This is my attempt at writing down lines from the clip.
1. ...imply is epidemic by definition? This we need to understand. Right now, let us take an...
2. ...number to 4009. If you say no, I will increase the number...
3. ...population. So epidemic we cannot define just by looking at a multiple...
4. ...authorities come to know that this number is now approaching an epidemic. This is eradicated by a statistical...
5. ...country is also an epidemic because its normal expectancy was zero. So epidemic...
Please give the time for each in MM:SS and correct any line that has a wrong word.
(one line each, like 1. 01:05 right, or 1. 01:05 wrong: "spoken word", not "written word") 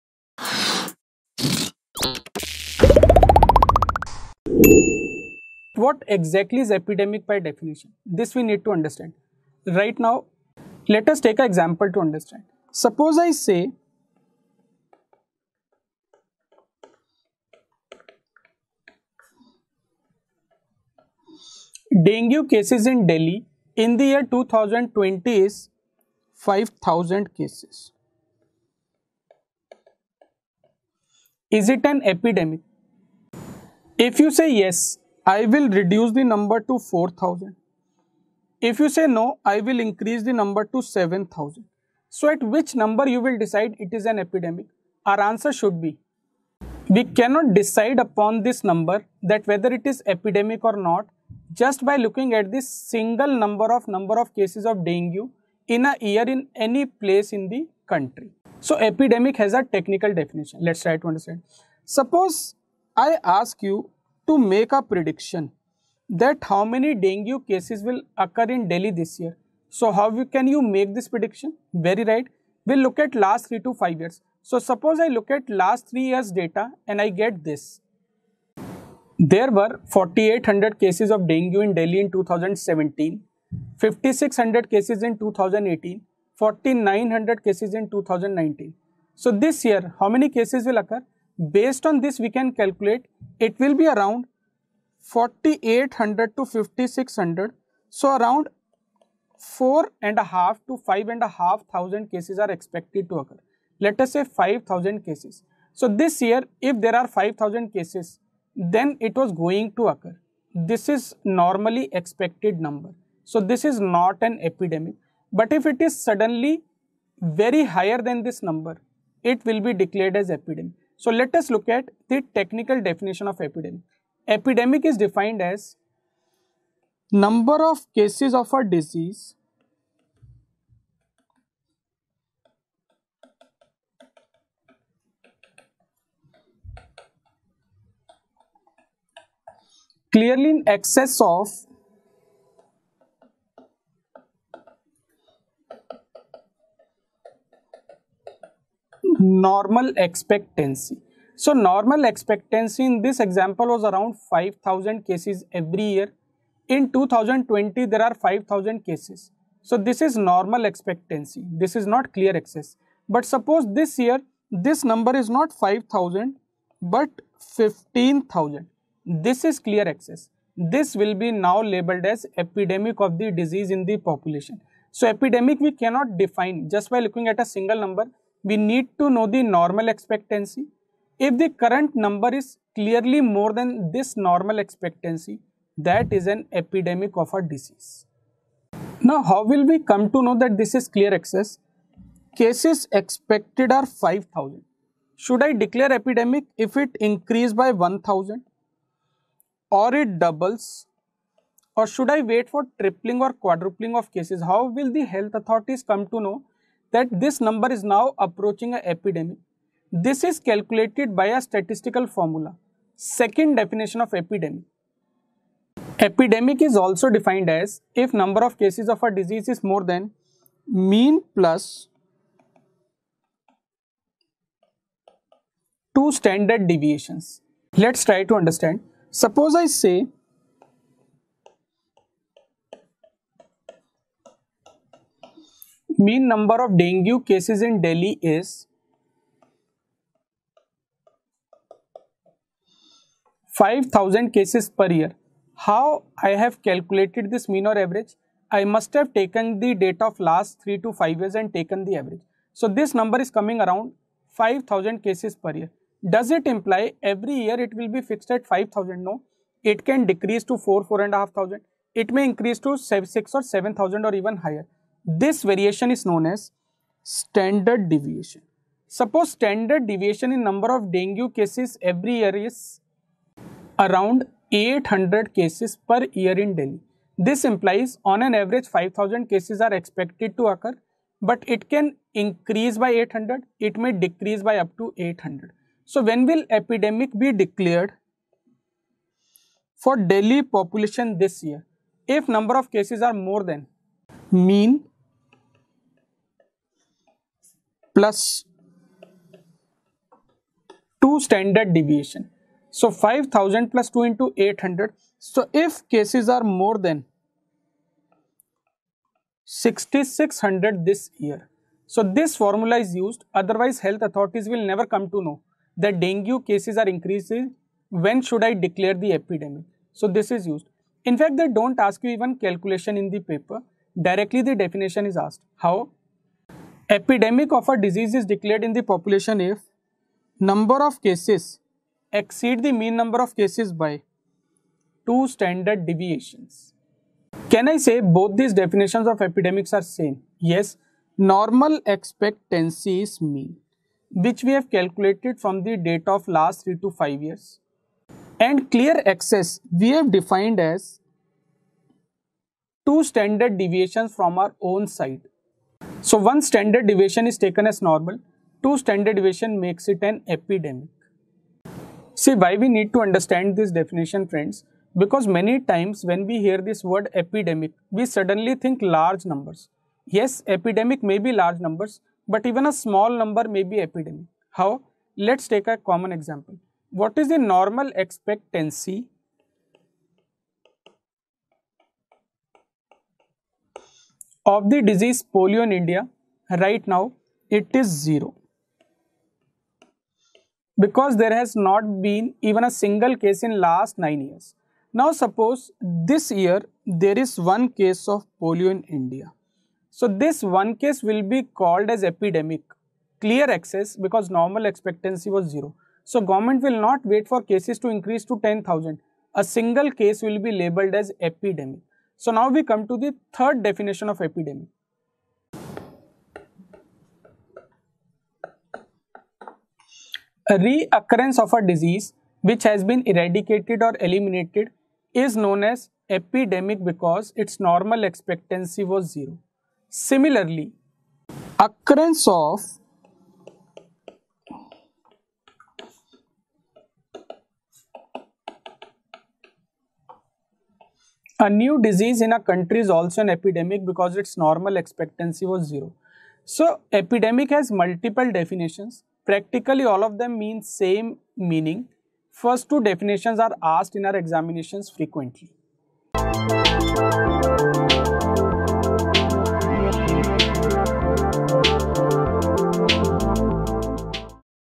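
1. 00:06 wrong: "exactly", not "imply"
2. 00:36 wrong: "4000", not "4009"
3. 02:53 wrong: "single", not "multiple"
4. 03:25 wrong: "calculated", not "eradicated"
5. 07:22 right.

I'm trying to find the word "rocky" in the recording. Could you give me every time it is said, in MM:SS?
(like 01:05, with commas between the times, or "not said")
not said.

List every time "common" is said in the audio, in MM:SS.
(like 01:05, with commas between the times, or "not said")
06:15.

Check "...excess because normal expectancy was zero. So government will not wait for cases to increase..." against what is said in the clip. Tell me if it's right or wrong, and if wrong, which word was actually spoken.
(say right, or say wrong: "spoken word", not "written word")
right.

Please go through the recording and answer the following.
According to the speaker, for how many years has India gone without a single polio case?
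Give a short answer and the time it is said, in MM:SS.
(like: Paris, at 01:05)
9 years, at 06:33.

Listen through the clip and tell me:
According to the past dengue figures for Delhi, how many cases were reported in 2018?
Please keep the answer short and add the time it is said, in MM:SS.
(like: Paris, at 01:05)
5600, at 01:23.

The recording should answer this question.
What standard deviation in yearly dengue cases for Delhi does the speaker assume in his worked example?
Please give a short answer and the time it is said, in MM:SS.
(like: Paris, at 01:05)
800, at 04:34.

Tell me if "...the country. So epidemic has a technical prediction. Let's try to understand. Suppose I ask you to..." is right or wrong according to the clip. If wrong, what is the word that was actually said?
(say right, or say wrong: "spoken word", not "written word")
wrong: "definition", not "prediction".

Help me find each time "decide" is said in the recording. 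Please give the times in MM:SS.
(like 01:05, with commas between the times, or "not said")
00:43, 00:47.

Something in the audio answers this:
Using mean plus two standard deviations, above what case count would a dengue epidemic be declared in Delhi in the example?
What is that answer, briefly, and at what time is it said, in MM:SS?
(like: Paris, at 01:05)
6600, at 05:09.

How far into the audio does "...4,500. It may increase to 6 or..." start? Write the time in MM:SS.
04:20.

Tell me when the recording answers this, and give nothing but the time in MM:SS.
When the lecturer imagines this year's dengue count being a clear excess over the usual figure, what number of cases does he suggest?
02:47.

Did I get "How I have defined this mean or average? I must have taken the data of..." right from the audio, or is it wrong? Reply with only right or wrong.
wrong.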